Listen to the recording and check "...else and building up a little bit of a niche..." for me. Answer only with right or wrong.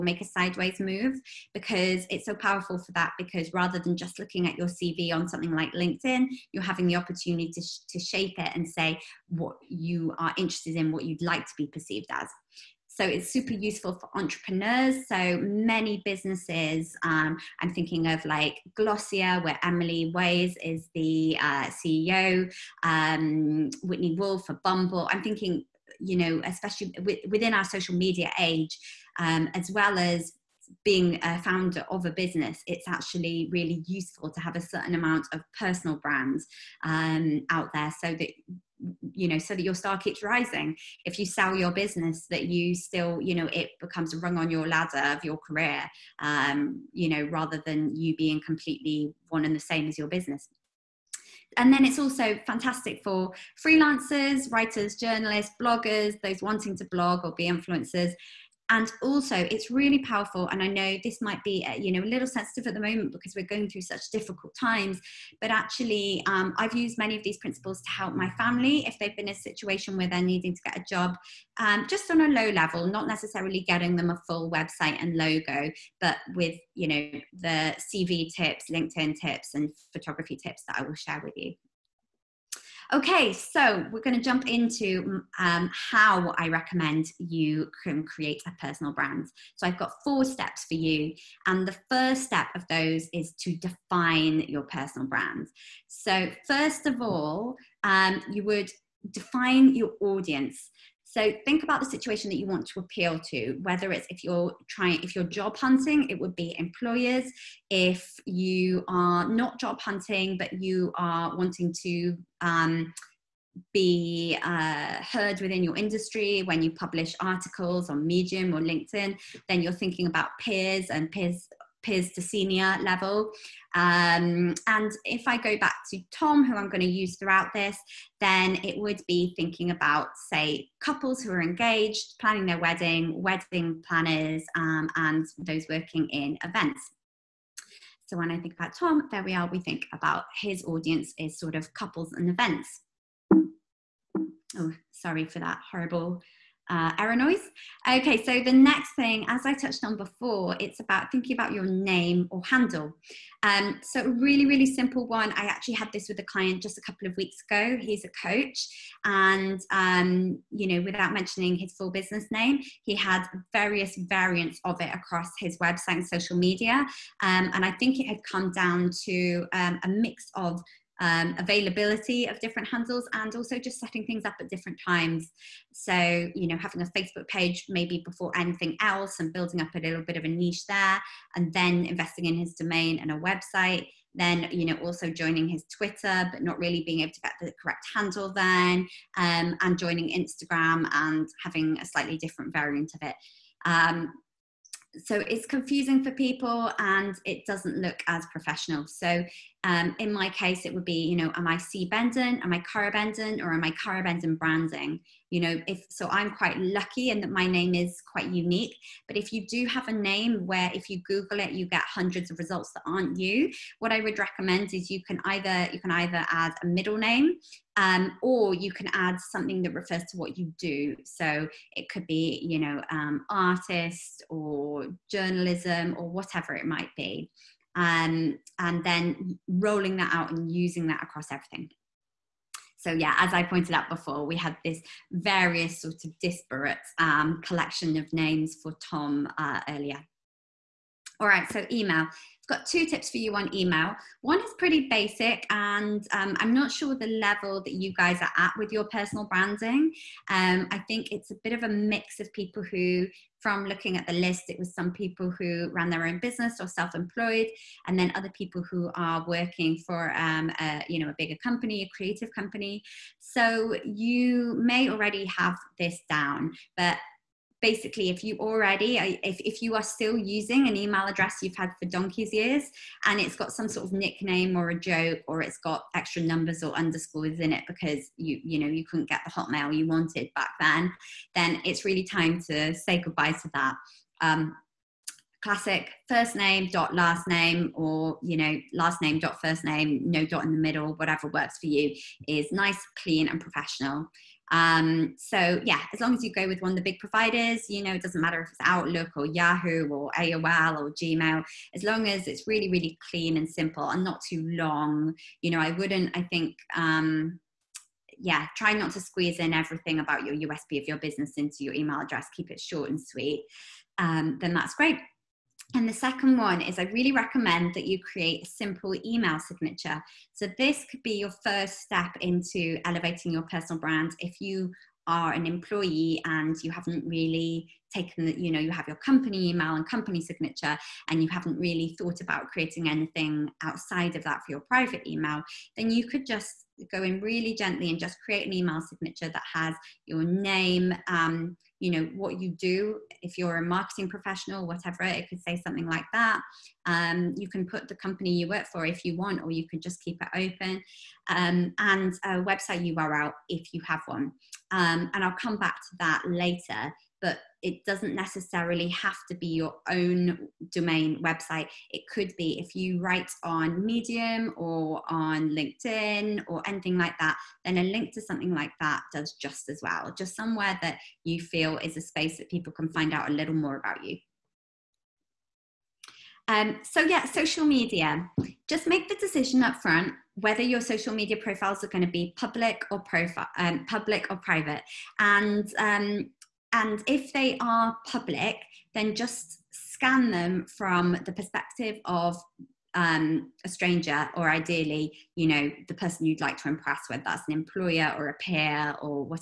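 right.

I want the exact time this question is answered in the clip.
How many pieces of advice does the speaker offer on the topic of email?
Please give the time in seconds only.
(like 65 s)
242 s.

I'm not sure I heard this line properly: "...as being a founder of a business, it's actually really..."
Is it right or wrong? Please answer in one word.
right.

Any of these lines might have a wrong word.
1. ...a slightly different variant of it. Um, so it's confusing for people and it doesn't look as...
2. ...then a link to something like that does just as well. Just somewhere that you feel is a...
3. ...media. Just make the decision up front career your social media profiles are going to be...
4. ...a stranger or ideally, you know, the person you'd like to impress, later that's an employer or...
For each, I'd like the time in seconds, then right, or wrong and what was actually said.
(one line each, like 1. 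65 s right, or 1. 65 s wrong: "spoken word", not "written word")
1. 191 s right
2. 367 s right
3. 377 s wrong: "whether", not "career"
4. 393 s wrong: "whether", not "later".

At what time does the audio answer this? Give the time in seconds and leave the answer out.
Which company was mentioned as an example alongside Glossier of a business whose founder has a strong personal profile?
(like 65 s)
24 s.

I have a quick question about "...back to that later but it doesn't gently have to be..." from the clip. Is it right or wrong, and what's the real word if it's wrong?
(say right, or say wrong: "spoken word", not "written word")
wrong: "necessarily", not "gently".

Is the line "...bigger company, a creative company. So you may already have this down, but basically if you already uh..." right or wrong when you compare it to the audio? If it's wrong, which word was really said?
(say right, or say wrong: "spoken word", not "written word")
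right.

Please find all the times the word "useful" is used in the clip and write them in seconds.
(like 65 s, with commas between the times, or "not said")
13 s, 33 s.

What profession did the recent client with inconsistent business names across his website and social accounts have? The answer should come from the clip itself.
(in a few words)
Coach.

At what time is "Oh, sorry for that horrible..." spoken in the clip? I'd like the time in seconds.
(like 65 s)
144 s.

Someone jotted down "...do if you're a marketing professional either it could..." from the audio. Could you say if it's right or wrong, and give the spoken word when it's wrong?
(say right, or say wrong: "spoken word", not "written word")
wrong: "whatever", not "either".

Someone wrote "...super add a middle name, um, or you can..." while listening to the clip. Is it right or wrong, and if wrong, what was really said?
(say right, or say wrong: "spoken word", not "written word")
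wrong: "either", not "super".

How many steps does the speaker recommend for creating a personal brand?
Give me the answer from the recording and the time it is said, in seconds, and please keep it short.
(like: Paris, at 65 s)
4, at 90 s.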